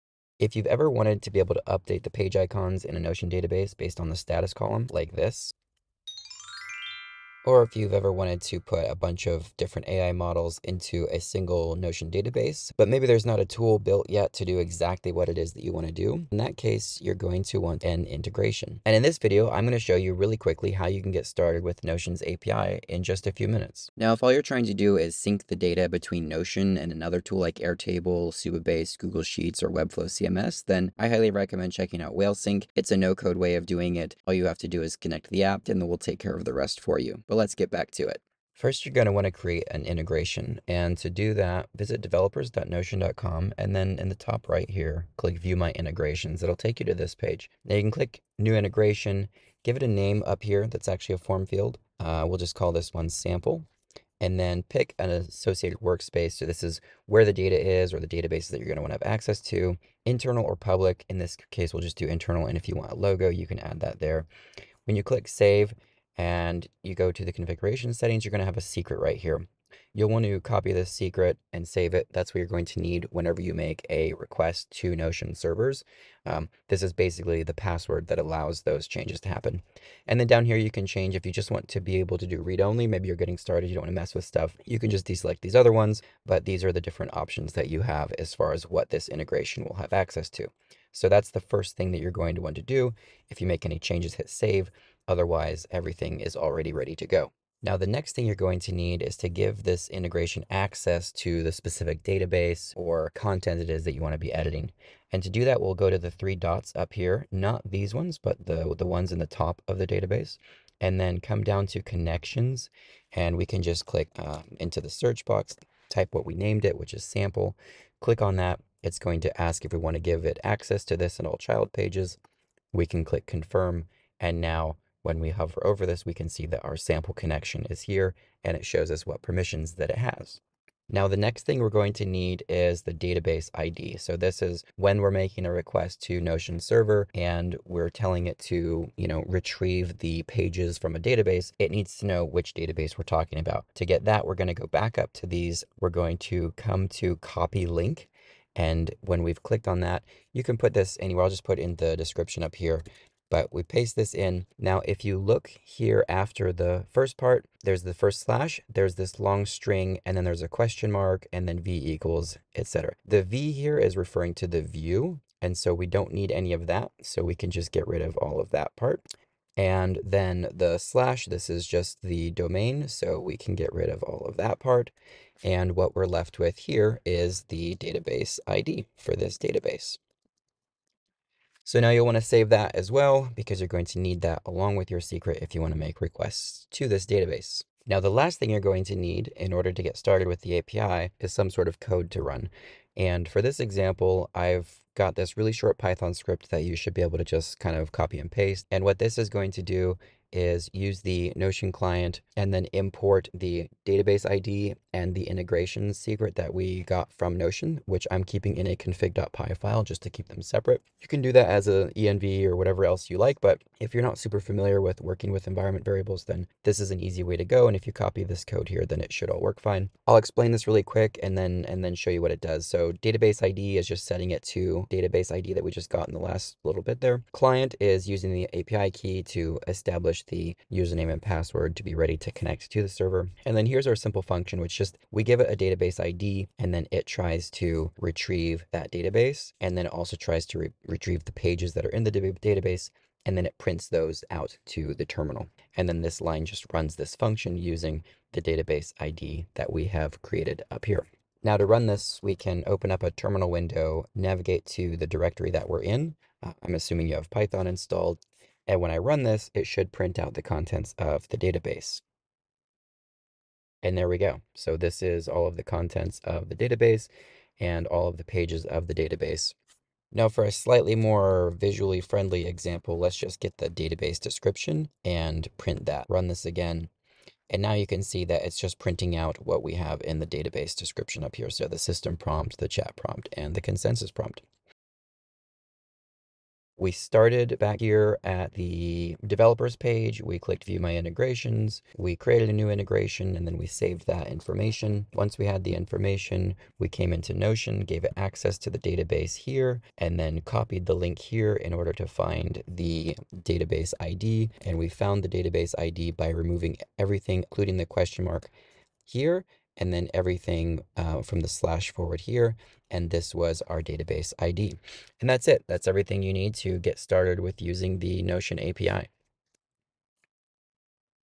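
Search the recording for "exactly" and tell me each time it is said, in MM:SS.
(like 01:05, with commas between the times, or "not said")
00:14.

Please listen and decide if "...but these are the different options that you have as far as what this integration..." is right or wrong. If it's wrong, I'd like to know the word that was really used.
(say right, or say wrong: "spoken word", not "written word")
right.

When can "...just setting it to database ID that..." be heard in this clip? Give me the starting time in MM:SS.
03:43.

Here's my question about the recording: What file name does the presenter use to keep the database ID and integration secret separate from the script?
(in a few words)
config.py.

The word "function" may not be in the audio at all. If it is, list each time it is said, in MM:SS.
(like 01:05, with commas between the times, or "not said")
03:54, 04:07.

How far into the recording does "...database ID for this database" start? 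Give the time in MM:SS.
02:57.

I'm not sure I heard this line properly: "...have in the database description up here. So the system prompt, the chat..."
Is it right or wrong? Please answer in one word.
right.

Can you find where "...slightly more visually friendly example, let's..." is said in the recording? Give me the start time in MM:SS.
04:30.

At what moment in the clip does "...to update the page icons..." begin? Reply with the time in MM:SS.
00:01.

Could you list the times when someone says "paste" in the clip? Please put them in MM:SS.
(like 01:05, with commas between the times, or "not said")
02:33, 03:18.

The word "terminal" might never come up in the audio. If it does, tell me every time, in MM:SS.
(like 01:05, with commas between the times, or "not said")
04:05, 04:13.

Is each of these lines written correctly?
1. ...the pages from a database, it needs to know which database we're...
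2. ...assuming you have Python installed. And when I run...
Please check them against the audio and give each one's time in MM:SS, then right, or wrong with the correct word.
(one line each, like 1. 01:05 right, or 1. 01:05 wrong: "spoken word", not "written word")
1. 02:19 right
2. 04:16 right.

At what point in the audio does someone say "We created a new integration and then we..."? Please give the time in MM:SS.
04:51.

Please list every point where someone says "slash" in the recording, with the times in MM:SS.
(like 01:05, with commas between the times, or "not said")
02:38, 02:50, 05:11.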